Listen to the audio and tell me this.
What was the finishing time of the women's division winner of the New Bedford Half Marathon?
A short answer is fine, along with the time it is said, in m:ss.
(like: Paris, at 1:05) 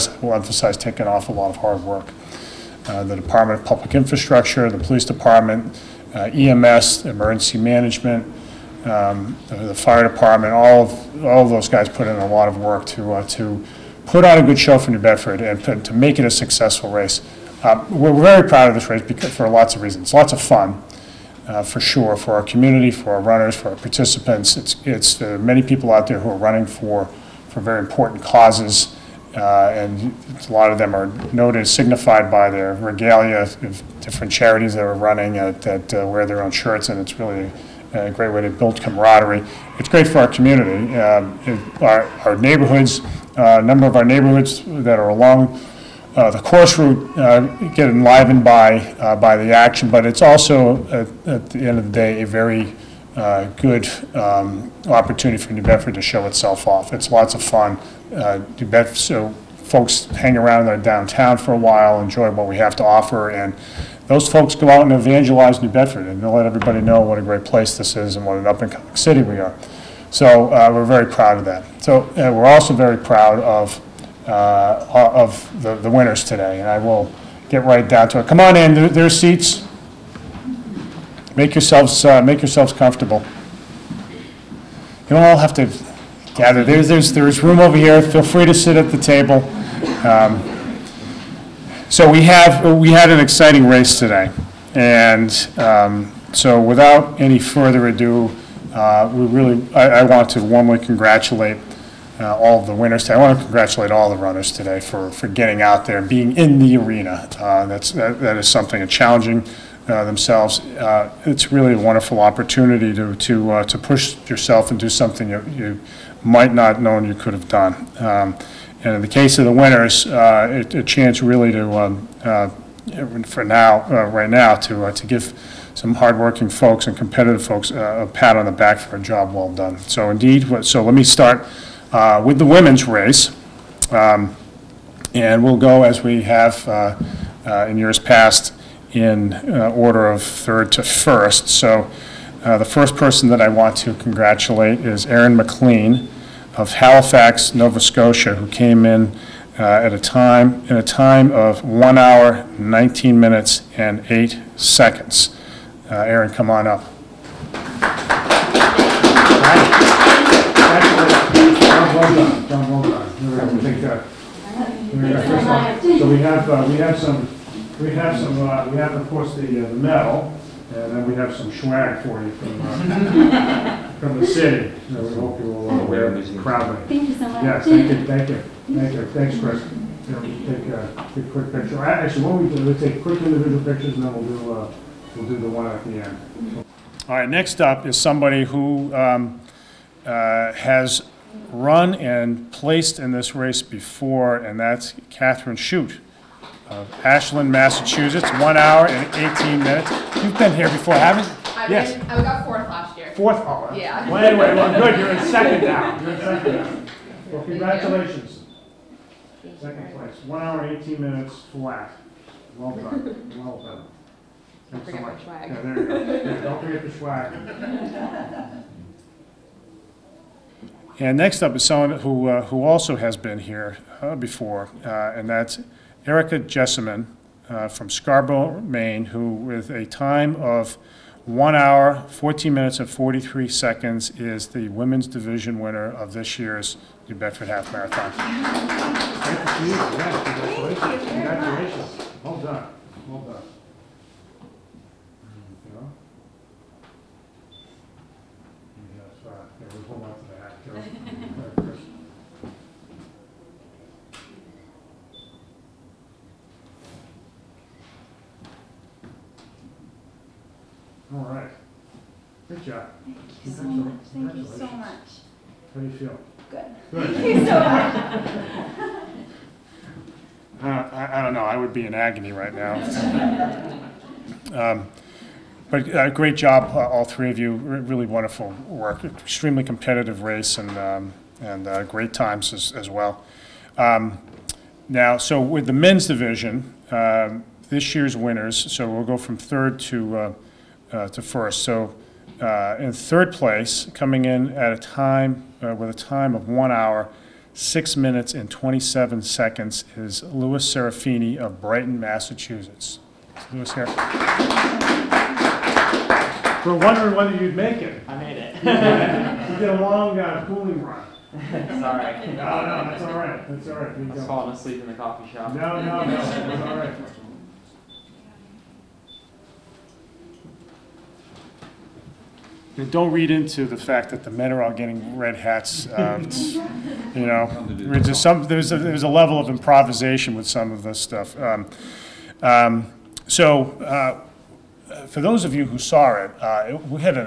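1:14:43, at 3:51.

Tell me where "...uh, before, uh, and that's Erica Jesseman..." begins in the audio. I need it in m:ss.
3:44.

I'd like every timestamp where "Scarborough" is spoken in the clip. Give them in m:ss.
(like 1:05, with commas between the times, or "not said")
3:47.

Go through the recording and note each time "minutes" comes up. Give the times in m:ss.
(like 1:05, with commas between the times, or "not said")
2:33, 3:19, 3:31, 3:52, 4:57.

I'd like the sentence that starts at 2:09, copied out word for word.
So indeed, so let me start uh, with the women's race.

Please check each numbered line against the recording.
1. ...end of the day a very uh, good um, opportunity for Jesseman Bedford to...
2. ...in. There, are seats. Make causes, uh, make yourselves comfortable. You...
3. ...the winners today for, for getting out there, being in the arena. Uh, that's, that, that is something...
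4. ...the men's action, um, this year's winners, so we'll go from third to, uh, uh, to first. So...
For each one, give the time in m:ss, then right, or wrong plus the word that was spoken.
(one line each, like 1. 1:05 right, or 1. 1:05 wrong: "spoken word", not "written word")
1. 0:51 wrong: "New", not "Jesseman"
2. 1:18 wrong: "yourselves", not "causes"
3. 1:44 wrong: "runners", not "winners"
4. 4:45 wrong: "division", not "action".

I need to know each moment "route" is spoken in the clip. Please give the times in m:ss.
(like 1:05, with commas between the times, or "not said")
0:46.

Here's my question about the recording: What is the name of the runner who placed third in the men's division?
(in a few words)
Louis Serafini.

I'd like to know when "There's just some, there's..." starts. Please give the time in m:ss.
5:27.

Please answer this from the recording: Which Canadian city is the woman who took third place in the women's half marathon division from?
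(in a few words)
Halifax, Nova Scotia.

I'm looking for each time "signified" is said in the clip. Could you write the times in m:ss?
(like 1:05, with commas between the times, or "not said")
0:31.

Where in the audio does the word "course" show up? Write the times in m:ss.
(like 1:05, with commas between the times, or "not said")
0:46, 2:49.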